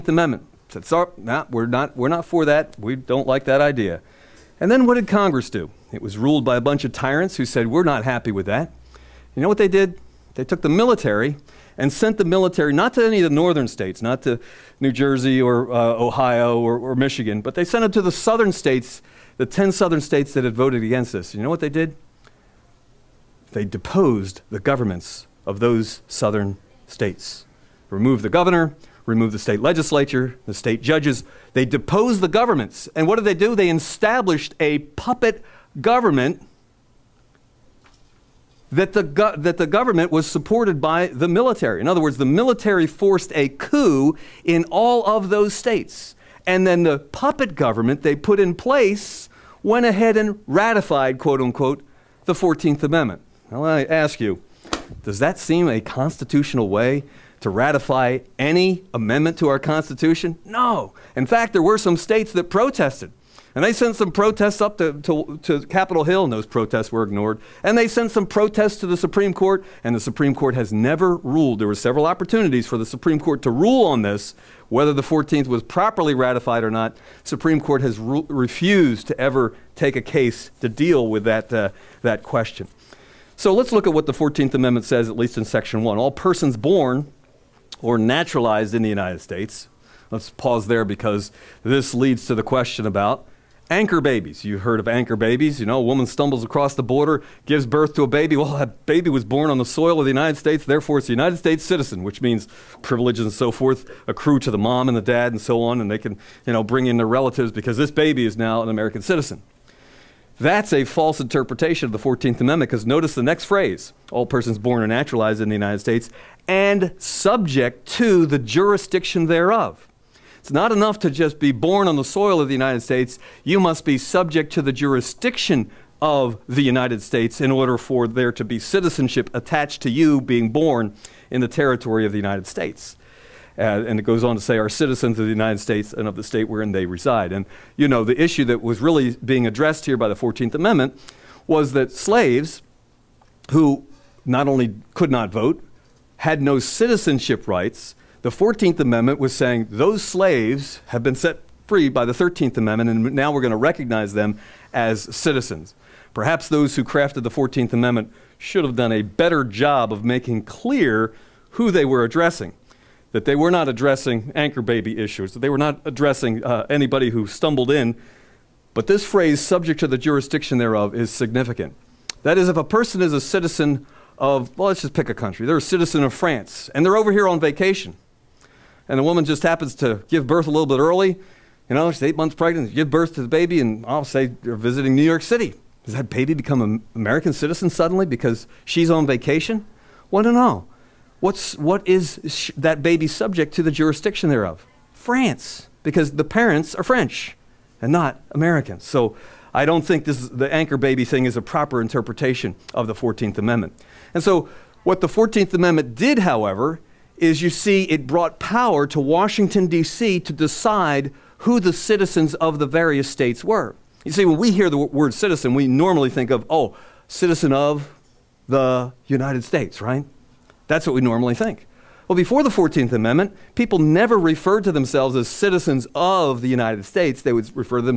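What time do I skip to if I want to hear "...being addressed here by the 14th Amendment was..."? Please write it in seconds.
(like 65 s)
139 s.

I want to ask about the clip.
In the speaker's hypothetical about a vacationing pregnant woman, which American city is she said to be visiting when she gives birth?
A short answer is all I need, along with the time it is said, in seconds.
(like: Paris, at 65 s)
New York City, at 184 s.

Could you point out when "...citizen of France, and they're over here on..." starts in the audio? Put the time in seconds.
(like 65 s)
175 s.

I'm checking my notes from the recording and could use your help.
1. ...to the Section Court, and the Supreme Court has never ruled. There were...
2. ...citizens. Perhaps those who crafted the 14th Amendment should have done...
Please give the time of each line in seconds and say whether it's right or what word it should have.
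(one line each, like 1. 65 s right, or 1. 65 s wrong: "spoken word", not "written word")
1. 68 s wrong: "Supreme", not "Section"
2. 155 s right.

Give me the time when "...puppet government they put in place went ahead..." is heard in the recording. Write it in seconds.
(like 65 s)
46 s.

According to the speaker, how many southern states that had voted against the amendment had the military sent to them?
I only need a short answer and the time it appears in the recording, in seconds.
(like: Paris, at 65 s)
10, at 19 s.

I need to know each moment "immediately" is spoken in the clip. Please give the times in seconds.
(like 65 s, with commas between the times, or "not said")
not said.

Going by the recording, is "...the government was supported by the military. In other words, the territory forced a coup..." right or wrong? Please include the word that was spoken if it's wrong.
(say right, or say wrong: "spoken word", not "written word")
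wrong: "military", not "territory".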